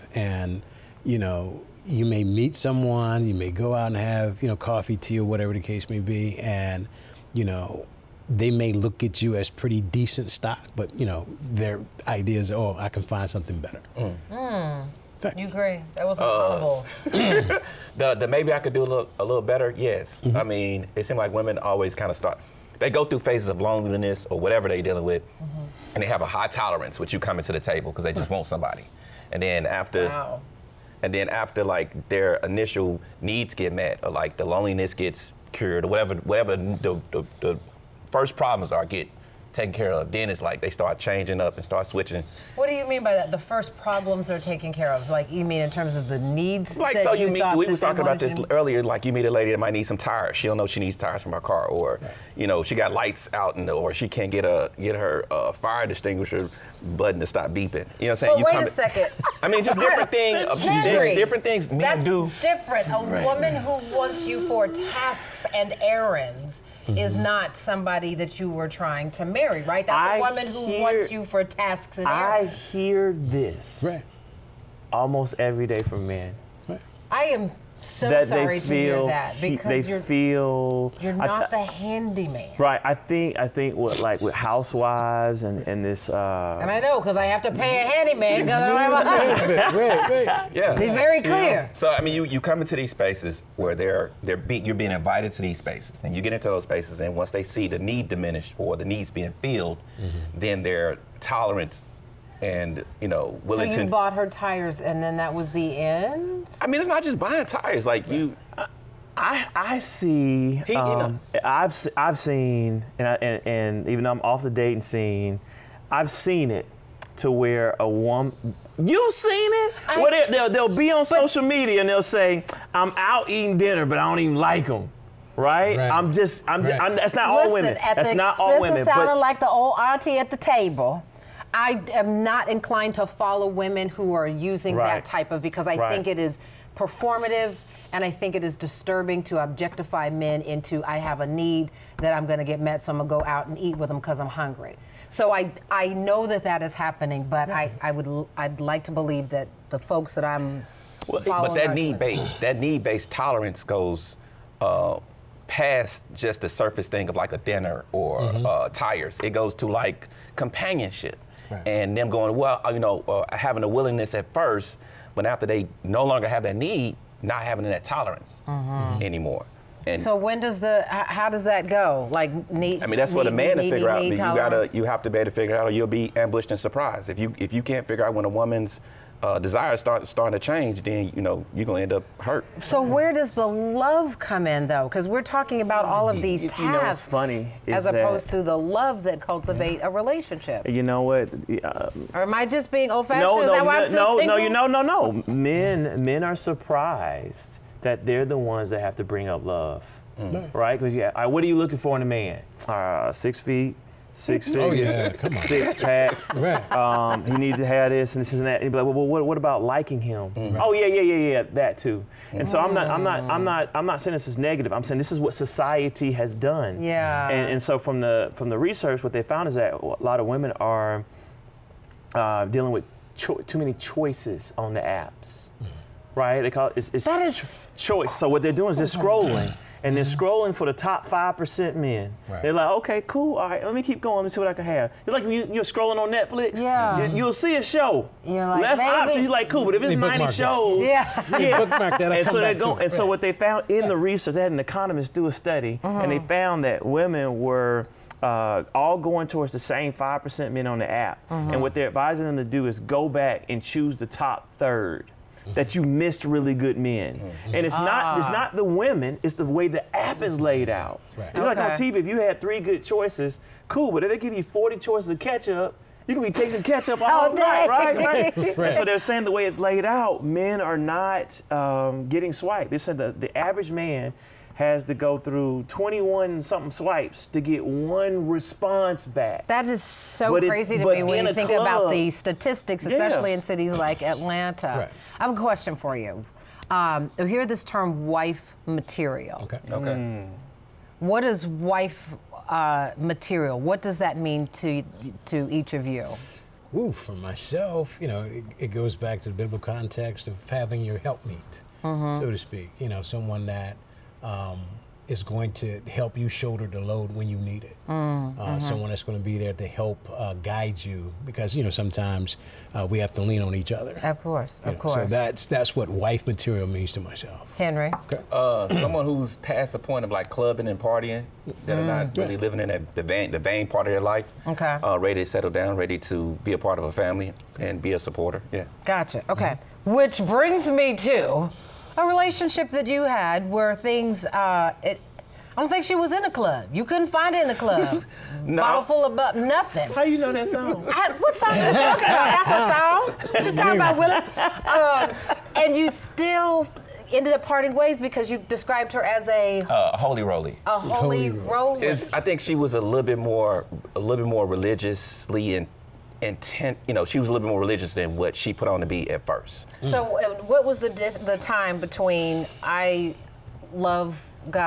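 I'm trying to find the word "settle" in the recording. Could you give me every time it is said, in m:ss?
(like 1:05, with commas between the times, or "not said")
5:25.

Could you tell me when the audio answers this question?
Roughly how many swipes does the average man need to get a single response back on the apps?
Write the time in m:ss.
4:35.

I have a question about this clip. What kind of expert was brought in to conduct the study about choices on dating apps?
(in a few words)
An economist.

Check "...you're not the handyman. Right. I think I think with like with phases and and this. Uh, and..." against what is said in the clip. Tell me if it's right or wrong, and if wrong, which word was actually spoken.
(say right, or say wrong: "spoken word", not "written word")
wrong: "housewives", not "phases".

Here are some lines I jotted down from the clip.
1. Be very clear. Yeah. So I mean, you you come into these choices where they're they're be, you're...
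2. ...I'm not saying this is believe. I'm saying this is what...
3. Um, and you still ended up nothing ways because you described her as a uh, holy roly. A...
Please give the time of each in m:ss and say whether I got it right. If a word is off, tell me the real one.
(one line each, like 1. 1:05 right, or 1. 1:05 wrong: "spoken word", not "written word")
1. 1:30 wrong: "spaces", not "choices"
2. 3:33 wrong: "negative", not "believe"
3. 5:44 wrong: "parting", not "nothing".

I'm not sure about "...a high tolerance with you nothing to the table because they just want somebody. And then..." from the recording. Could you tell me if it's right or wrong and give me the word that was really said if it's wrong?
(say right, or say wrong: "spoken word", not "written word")
wrong: "coming", not "nothing".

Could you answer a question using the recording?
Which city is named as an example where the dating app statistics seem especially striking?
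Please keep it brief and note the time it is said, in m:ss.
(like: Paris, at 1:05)
Atlanta, at 4:44.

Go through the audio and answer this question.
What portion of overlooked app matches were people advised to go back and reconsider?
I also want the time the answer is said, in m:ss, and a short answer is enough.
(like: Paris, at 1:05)
The top third, at 4:14.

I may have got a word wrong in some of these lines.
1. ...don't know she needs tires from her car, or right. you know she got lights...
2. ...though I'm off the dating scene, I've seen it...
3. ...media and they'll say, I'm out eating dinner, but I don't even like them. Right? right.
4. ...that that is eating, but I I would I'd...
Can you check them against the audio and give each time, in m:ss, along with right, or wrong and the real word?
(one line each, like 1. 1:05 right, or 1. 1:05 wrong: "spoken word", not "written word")
1. 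0:50 right
2. 1:54 right
3. 2:01 right
4. 2:26 wrong: "happening", not "eating".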